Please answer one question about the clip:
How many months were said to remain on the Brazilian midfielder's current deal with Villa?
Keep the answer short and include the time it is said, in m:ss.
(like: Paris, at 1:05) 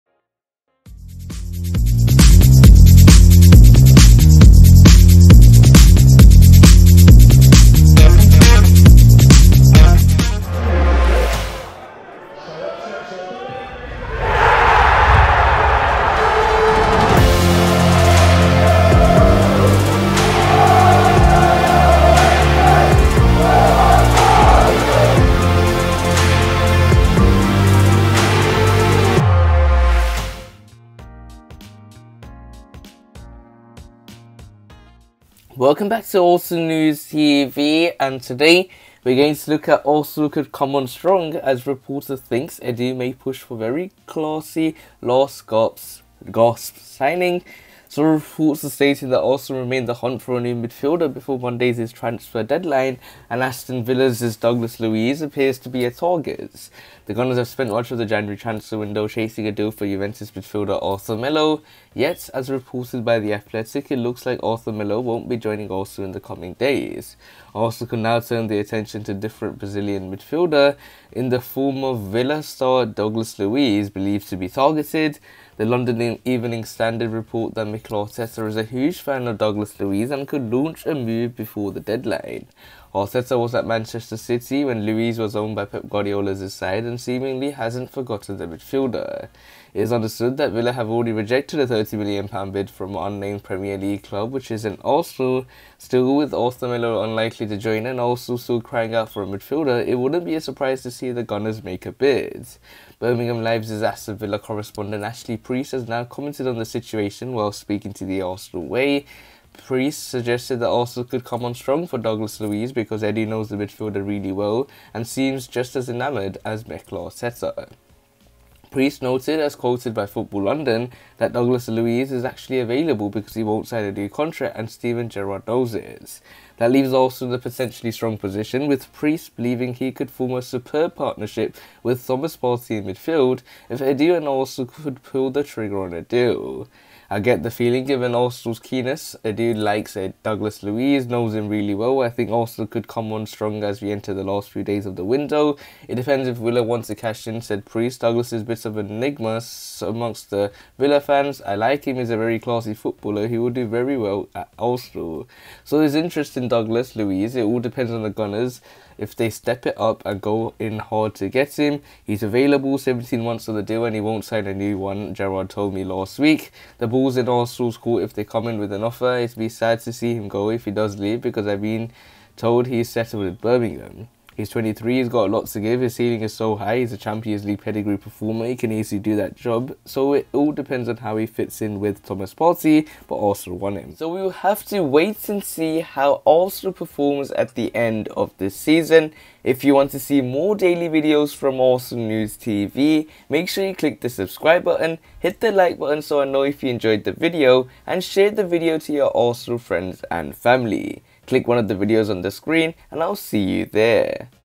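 17, at 2:42.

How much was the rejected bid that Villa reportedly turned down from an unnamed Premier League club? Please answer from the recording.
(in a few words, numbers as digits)
£30 million.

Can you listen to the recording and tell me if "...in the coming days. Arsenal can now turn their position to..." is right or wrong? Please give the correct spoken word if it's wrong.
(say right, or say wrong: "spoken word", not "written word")
wrong: "attention", not "position".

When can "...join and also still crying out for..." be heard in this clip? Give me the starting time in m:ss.
1:37.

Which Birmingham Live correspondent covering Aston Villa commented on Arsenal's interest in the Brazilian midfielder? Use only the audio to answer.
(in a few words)
Ashley Priest.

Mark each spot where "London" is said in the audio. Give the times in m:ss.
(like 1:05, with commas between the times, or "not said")
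1:15, 2:00.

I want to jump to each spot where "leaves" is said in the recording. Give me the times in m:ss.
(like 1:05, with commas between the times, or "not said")
2:06, 2:50.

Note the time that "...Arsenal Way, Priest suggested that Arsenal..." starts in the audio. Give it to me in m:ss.
1:48.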